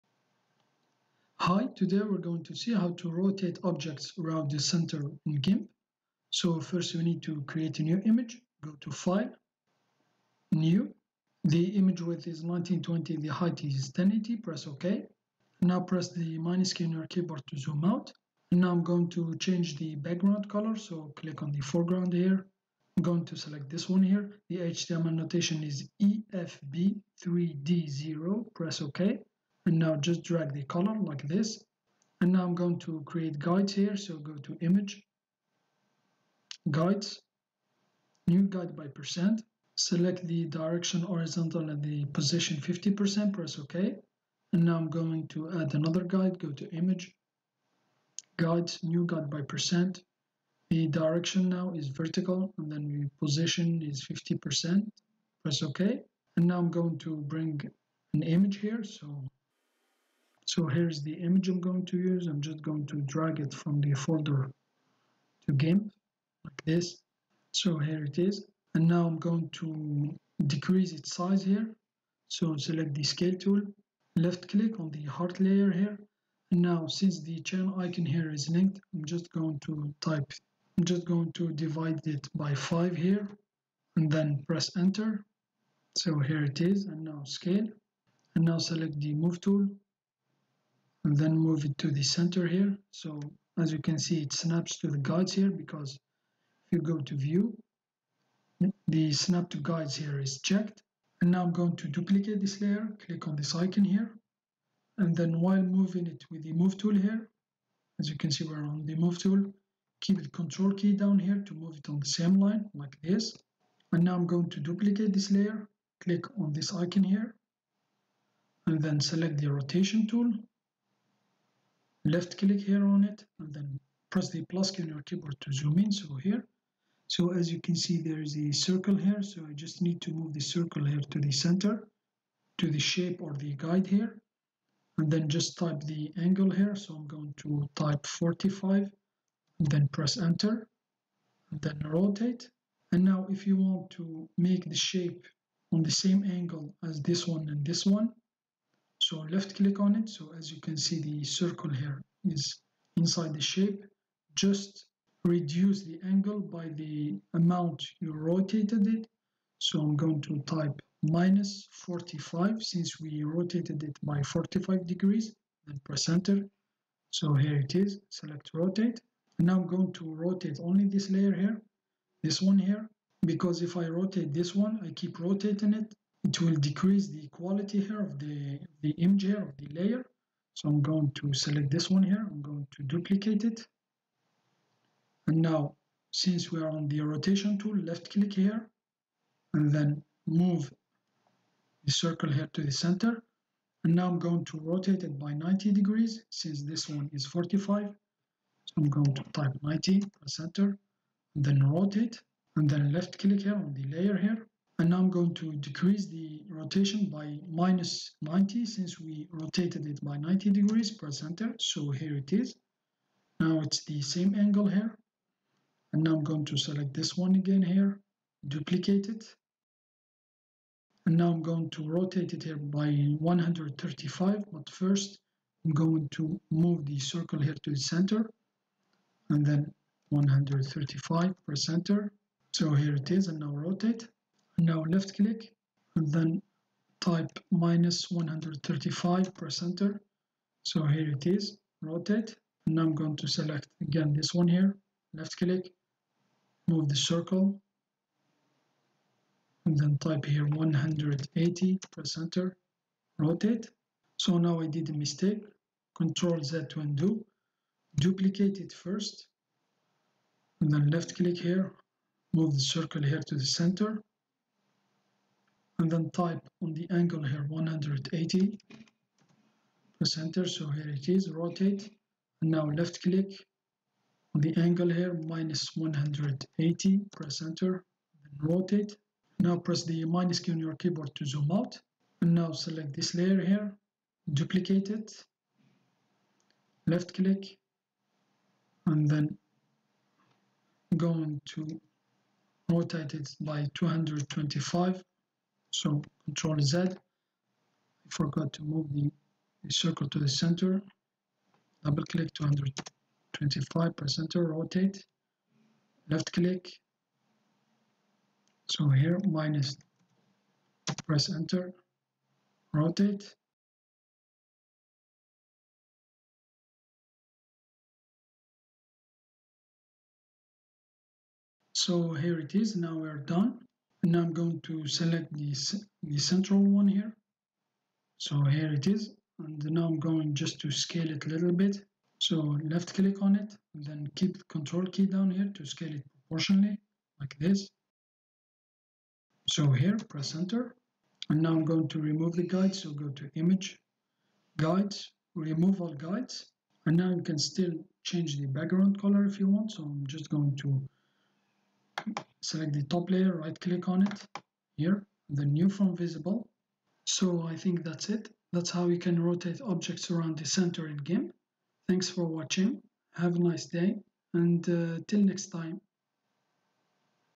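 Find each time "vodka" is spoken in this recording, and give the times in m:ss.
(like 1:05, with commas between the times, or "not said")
not said.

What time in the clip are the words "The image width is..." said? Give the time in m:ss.
0:11.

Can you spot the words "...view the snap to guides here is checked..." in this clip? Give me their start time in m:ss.
1:37.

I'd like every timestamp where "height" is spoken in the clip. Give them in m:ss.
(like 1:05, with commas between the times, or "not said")
0:13.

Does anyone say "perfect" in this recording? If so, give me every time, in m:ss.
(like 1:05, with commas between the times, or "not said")
not said.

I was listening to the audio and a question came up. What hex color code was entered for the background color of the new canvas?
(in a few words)
EFB3D0.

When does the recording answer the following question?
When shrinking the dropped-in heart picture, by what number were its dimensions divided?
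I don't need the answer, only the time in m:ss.
1:22.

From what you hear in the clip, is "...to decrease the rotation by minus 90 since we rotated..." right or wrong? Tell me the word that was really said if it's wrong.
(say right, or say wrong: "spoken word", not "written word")
right.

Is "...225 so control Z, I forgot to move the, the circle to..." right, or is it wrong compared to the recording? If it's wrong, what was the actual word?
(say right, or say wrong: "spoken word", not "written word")
right.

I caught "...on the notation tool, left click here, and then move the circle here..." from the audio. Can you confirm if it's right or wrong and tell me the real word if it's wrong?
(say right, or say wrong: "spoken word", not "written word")
wrong: "rotation", not "notation".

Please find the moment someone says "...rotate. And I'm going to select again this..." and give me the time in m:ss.
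4:01.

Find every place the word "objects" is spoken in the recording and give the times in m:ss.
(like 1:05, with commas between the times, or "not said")
0:03, 5:59.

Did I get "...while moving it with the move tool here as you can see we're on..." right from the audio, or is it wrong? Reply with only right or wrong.
right.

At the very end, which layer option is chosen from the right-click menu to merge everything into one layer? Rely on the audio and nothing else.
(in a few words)
New from visible.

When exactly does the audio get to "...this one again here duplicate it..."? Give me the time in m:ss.
3:36.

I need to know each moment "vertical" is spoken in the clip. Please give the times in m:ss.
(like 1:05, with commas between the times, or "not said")
0:51.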